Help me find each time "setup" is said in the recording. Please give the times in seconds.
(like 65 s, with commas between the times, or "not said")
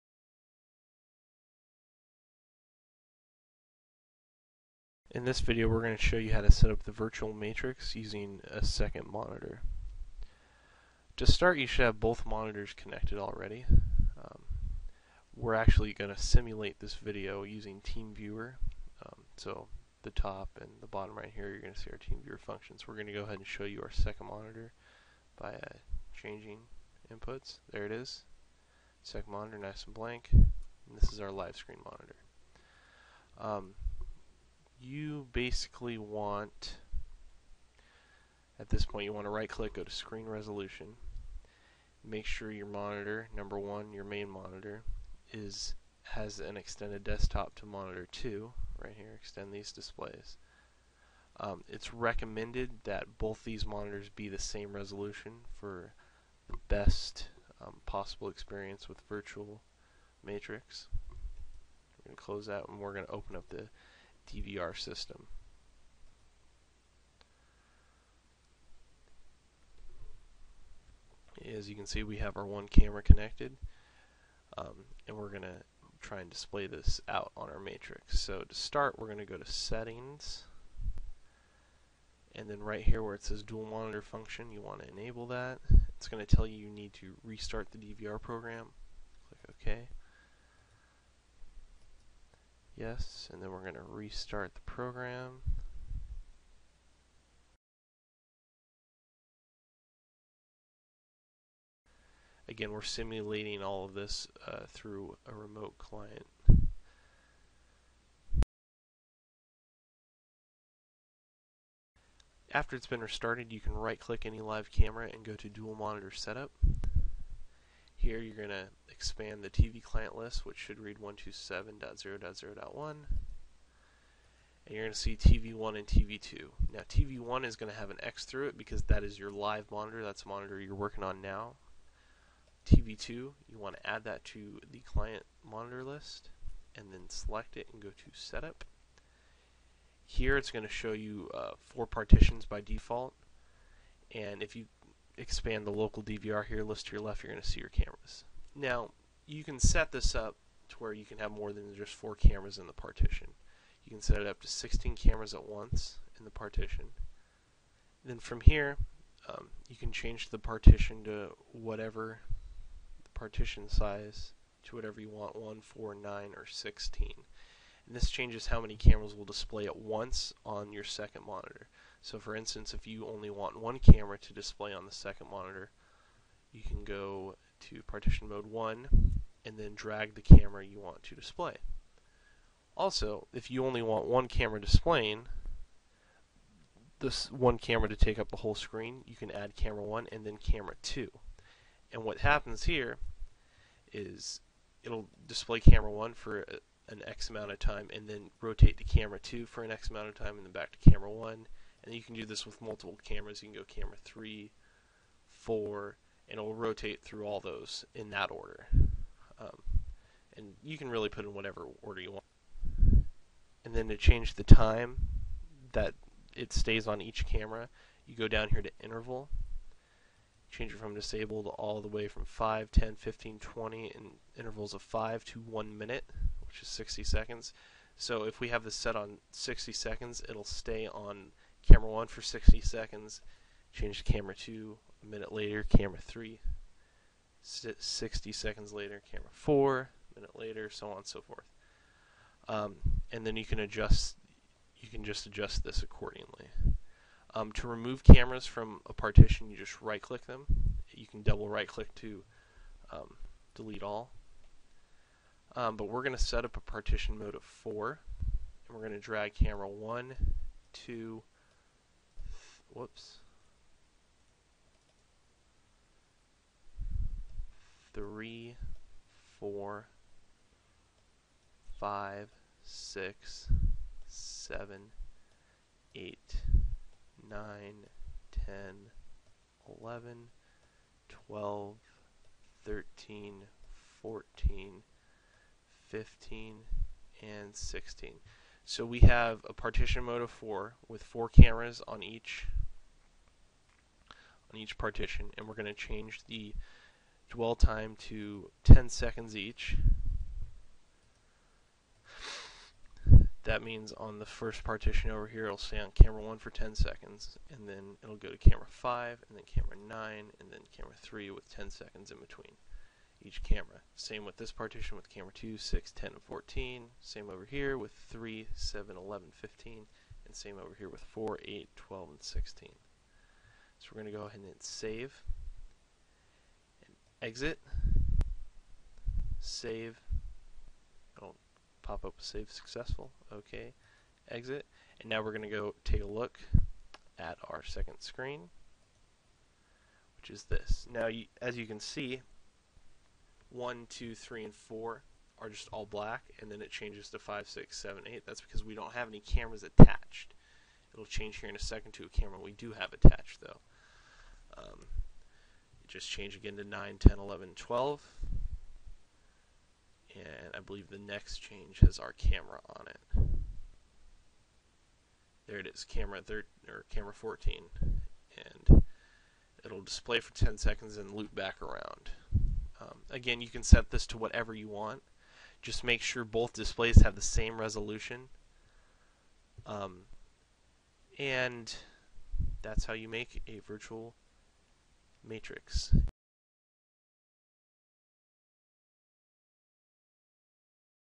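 116 s, 138 s.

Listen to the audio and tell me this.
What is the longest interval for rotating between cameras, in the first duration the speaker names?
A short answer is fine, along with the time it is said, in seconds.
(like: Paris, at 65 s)
1 minute, at 225 s.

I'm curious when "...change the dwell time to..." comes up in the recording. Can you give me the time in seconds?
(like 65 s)
295 s.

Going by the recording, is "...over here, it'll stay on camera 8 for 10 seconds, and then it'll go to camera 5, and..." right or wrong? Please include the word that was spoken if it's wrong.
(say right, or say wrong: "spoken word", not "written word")
wrong: "1", not "8".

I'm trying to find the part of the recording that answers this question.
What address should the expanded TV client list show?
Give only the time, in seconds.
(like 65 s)
120 s.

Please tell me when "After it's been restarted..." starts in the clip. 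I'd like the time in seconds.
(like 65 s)
112 s.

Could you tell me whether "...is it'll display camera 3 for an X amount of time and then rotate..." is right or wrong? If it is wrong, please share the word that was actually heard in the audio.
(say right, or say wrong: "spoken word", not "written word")
wrong: "1", not "3".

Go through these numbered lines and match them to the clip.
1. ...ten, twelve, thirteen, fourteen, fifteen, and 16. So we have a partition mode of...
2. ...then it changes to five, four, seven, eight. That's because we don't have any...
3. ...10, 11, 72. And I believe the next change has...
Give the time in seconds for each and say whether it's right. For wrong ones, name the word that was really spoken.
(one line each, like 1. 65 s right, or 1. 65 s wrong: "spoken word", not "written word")
1. 279 s wrong: "eleven", not "ten"
2. 346 s wrong: "six", not "four"
3. 356 s wrong: "12", not "72".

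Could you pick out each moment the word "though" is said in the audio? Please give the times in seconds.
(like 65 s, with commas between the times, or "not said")
353 s.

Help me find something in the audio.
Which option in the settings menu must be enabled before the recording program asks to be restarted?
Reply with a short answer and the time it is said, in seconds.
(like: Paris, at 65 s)
Dual Monitor Function, at 83 s.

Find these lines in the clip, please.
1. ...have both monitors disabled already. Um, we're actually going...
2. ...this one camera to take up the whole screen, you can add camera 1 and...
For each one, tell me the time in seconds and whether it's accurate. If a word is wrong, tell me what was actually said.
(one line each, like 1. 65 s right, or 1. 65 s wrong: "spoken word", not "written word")
1. 11 s wrong: "connected", not "disabled"
2. 186 s right.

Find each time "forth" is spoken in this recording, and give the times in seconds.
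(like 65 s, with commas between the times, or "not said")
241 s.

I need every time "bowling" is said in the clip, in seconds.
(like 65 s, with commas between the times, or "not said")
not said.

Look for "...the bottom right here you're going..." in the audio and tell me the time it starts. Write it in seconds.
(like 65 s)
20 s.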